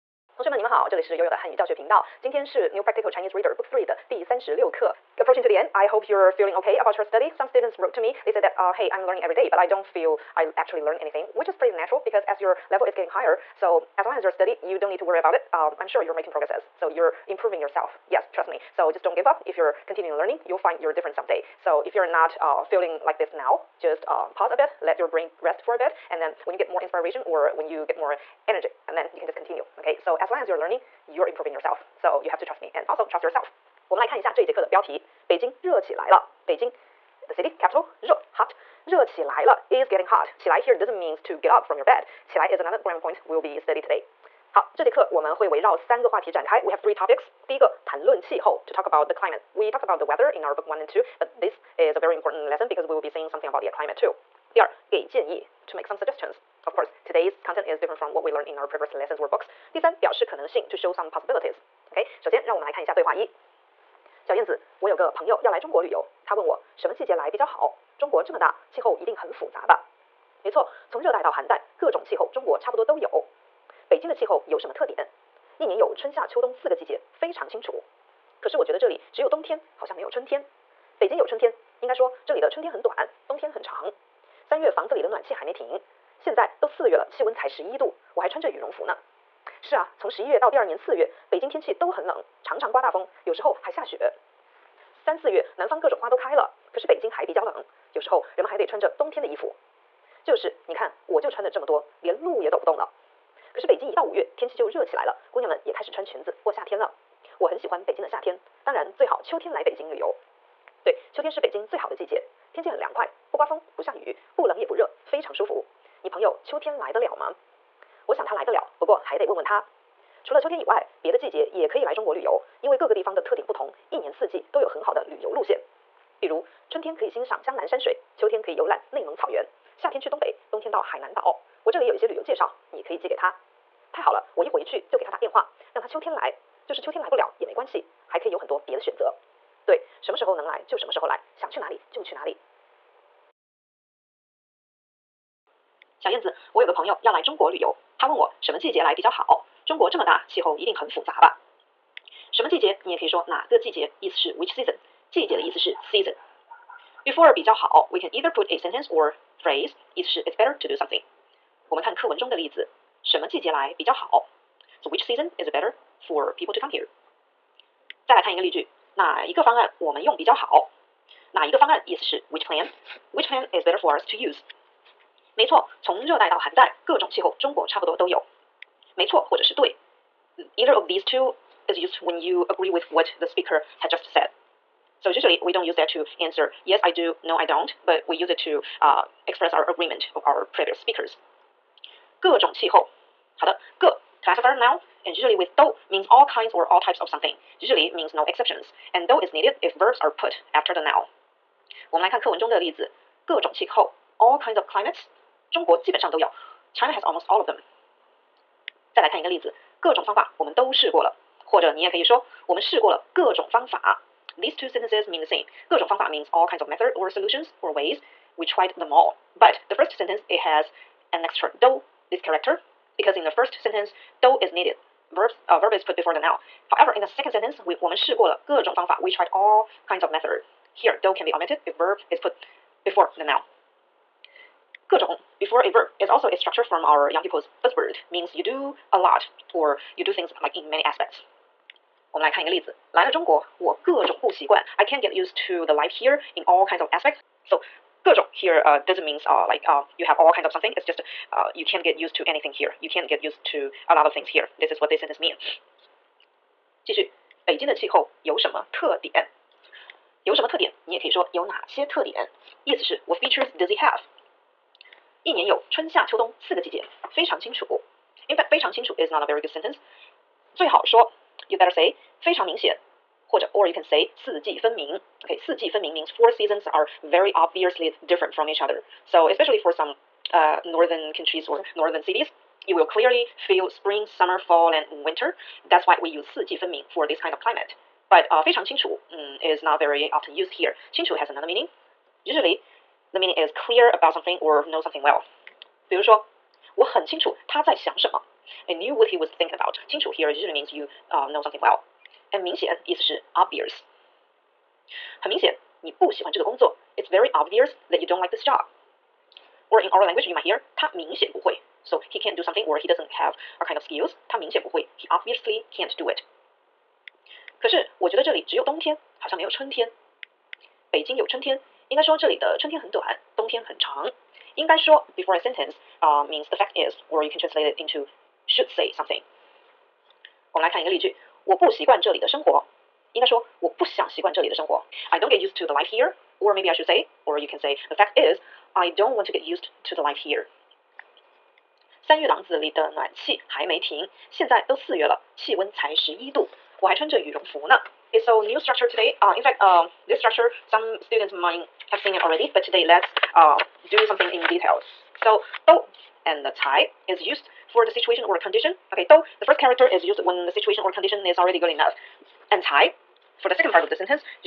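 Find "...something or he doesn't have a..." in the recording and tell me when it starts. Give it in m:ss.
5:12.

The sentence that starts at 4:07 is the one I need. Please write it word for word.
So, 各 种 here uh, doesn't means uh, like uh, you have all kinds of something.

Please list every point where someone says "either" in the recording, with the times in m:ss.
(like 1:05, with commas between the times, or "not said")
2:38, 2:55.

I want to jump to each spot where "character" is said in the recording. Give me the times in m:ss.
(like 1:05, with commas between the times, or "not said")
3:42, 5:59.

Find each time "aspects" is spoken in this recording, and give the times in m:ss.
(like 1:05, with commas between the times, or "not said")
4:00, 4:06.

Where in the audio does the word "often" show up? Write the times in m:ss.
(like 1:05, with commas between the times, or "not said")
4:50.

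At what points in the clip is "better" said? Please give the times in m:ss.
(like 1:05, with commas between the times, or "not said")
2:40, 2:45, 2:53, 4:31.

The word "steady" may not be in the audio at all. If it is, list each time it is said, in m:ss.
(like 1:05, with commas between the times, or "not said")
0:14.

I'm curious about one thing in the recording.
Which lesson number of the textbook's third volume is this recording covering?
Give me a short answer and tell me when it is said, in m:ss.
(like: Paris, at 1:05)
36, at 0:04.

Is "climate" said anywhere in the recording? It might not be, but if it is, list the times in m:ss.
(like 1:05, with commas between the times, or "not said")
0:49, 0:53, 3:24, 4:47.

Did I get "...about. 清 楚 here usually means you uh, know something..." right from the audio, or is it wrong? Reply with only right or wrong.
right.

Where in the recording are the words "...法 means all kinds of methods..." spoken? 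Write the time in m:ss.
3:35.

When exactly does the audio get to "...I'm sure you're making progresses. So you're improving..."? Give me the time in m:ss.
0:15.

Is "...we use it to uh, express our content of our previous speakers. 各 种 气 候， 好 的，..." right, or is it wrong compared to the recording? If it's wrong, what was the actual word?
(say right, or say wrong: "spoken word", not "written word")
wrong: "agreement", not "content".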